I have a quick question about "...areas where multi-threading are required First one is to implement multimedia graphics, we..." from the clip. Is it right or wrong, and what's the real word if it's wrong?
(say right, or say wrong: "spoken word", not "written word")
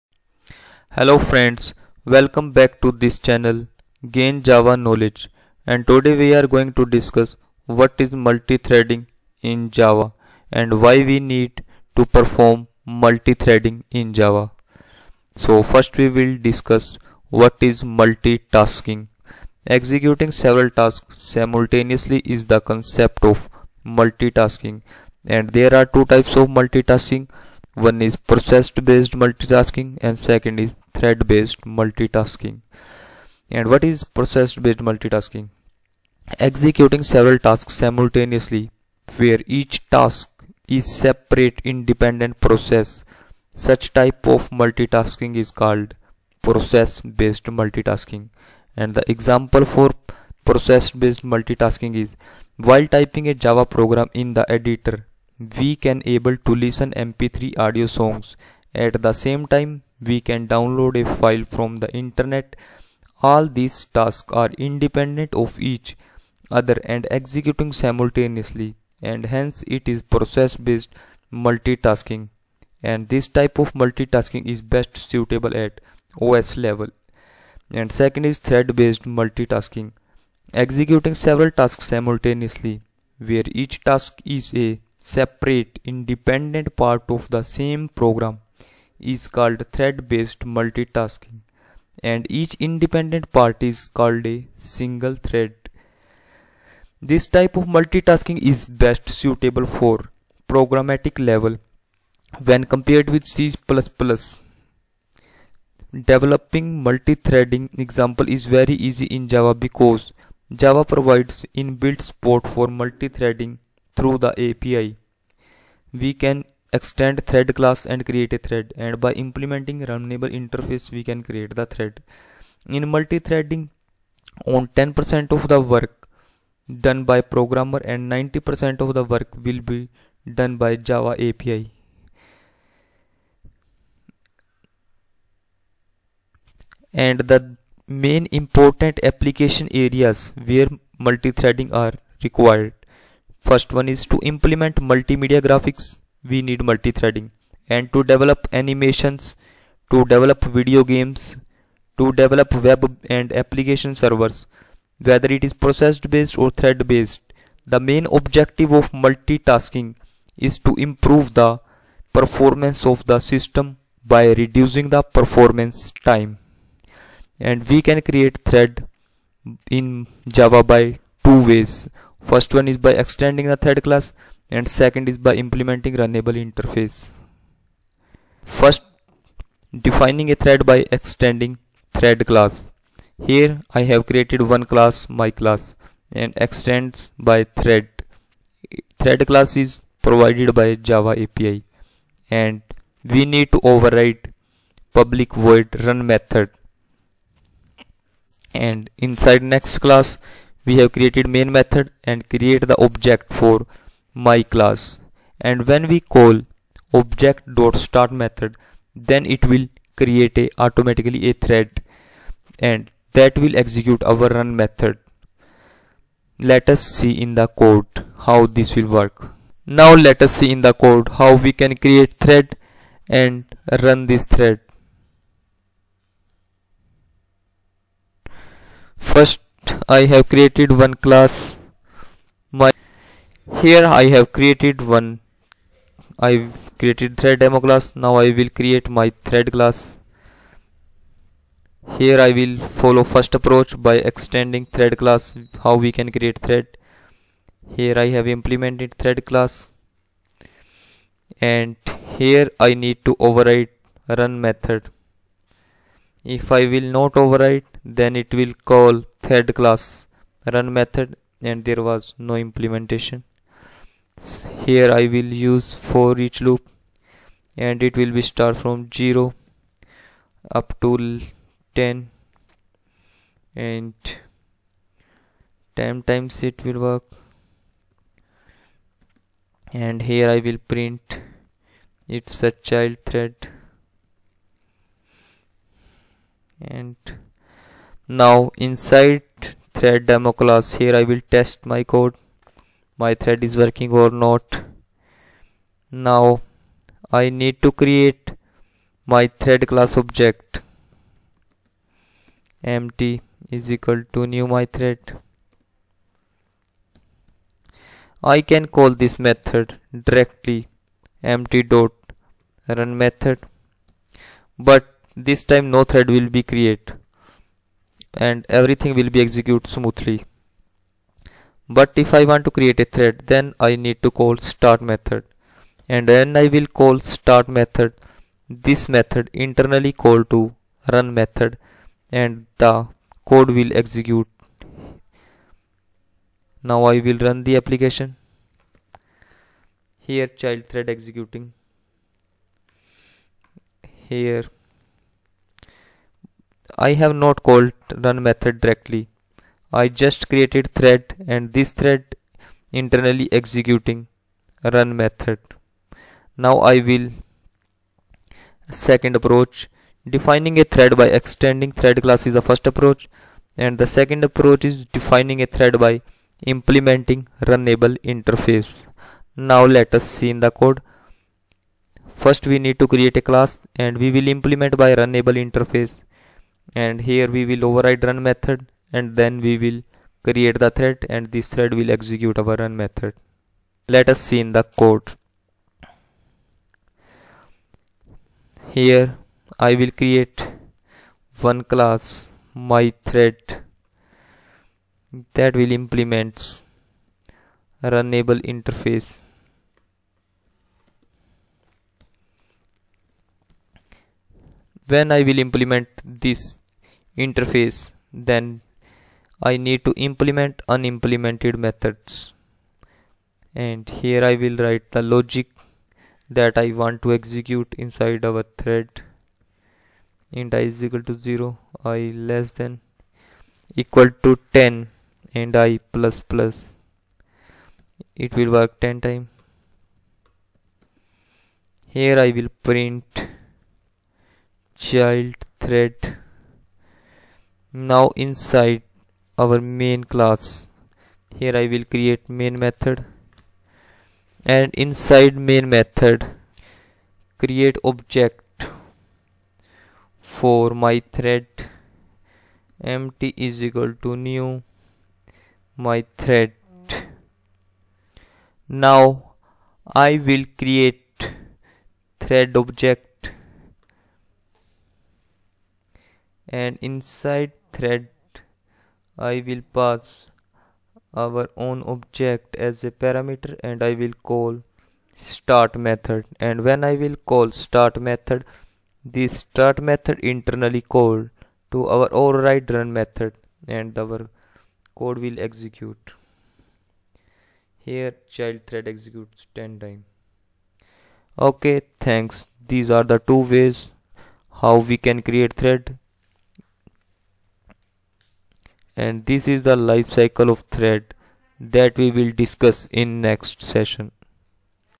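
right.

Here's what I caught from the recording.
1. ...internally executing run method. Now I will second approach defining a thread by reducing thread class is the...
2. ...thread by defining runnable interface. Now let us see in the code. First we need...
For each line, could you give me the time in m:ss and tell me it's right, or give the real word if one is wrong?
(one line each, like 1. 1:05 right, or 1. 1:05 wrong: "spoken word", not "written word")
1. 5:52 wrong: "extending", not "reducing"
2. 6:05 wrong: "implementing", not "defining".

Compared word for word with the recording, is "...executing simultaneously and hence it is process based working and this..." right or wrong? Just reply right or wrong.
wrong.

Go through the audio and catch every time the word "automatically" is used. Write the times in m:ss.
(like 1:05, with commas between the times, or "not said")
3:30.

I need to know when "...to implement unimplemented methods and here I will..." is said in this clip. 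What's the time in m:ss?
6:49.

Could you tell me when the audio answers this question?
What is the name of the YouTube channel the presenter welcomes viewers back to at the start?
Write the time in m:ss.
0:04.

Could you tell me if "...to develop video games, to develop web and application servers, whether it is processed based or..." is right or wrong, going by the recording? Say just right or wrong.
right.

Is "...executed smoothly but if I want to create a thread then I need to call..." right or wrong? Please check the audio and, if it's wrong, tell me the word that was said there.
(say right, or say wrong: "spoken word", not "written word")
right.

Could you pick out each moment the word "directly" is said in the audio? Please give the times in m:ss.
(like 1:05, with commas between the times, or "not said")
5:10, 5:48.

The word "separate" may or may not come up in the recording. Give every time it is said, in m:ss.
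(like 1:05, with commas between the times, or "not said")
0:40, 1:25.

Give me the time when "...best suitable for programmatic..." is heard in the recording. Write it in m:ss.
1:38.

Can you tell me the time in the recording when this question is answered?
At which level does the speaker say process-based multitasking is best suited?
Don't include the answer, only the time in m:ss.
1:16.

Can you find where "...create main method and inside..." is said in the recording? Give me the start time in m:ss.
7:21.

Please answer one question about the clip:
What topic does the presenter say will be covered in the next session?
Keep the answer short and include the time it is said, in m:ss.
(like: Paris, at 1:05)
Life cycle of thread, at 8:19.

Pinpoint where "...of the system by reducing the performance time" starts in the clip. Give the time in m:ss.
2:42.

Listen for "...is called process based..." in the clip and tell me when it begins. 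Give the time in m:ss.
0:45.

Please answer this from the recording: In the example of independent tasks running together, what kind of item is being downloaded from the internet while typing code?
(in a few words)
A file.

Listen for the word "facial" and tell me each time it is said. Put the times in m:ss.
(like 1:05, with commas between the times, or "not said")
not said.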